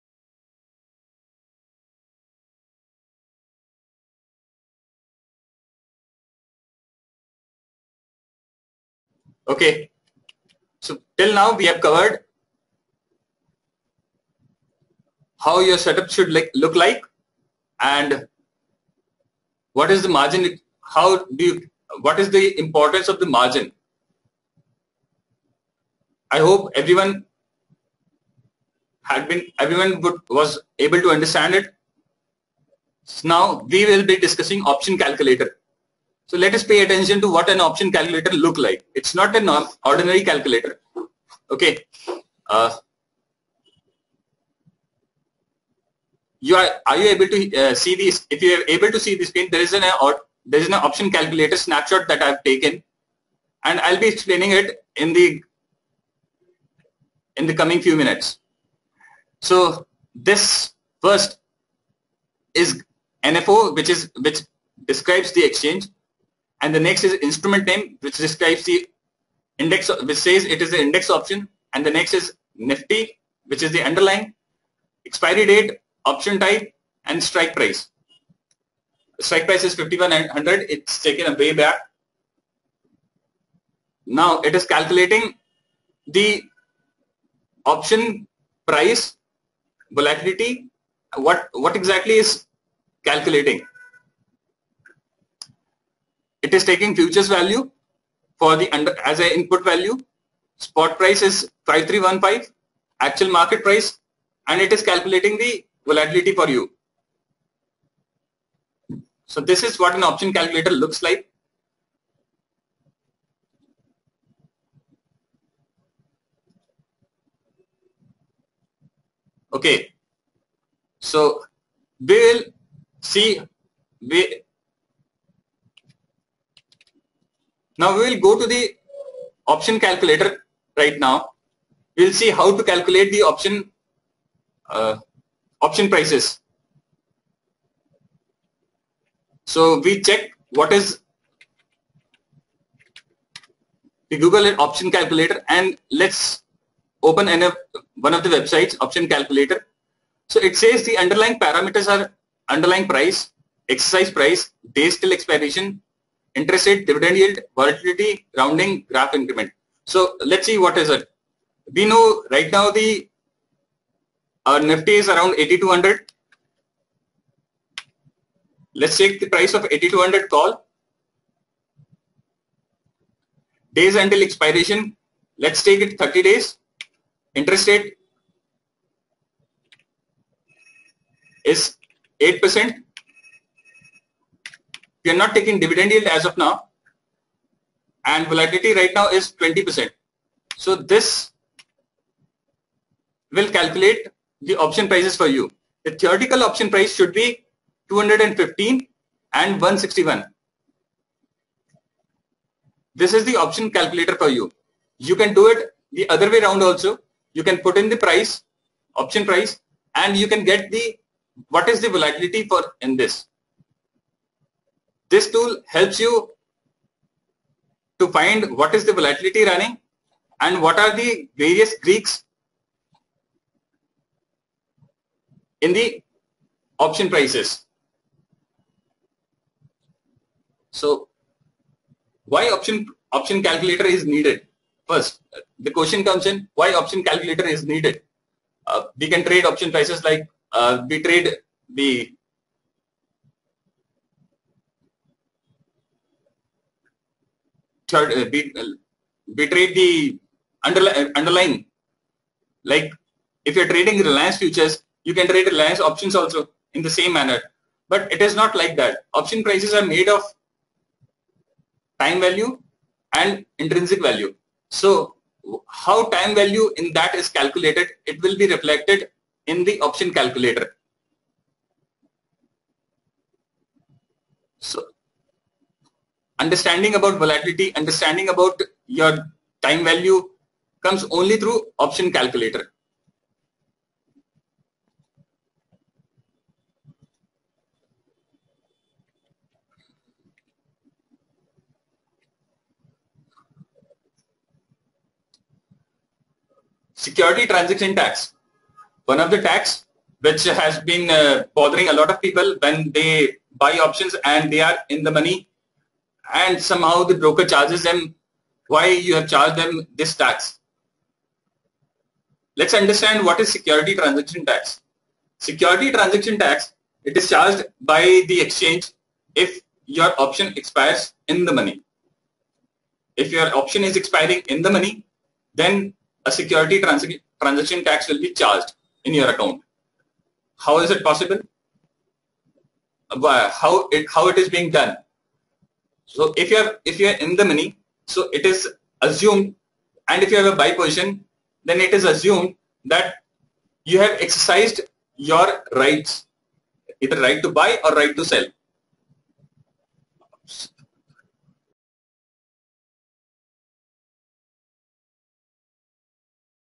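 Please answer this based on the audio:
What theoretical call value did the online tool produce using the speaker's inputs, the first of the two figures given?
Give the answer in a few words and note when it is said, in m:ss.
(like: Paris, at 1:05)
215, at 3:17.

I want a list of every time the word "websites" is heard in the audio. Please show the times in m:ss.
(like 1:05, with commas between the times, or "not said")
2:28.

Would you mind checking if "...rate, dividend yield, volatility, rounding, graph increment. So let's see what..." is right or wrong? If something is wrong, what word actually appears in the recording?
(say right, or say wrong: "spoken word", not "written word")
right.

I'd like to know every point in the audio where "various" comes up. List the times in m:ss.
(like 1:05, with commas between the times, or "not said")
3:41.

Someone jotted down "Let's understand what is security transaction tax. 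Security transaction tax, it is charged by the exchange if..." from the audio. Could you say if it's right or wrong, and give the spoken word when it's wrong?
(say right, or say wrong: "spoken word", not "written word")
right.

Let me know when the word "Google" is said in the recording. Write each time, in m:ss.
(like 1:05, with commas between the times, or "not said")
2:24.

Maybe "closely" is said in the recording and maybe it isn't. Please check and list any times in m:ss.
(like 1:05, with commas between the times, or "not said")
not said.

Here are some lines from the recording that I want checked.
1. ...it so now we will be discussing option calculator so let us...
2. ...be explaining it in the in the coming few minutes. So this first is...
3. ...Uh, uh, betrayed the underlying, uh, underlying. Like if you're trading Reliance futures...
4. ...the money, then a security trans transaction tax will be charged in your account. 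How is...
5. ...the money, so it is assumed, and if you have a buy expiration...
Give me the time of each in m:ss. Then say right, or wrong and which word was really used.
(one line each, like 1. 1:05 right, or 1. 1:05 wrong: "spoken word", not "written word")
1. 0:31 right
2. 0:53 right
3. 4:07 right
4. 5:24 right
5. 5:37 wrong: "position", not "expiration".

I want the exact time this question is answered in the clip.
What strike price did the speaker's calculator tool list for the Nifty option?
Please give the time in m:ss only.
1:19.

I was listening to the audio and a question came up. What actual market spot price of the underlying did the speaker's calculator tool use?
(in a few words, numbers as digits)
5315.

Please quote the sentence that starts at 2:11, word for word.
We'll see how to calculate the option uh, option prices.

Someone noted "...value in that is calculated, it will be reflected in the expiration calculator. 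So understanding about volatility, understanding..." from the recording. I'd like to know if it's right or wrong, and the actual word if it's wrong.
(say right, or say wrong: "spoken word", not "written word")
wrong: "option", not "expiration".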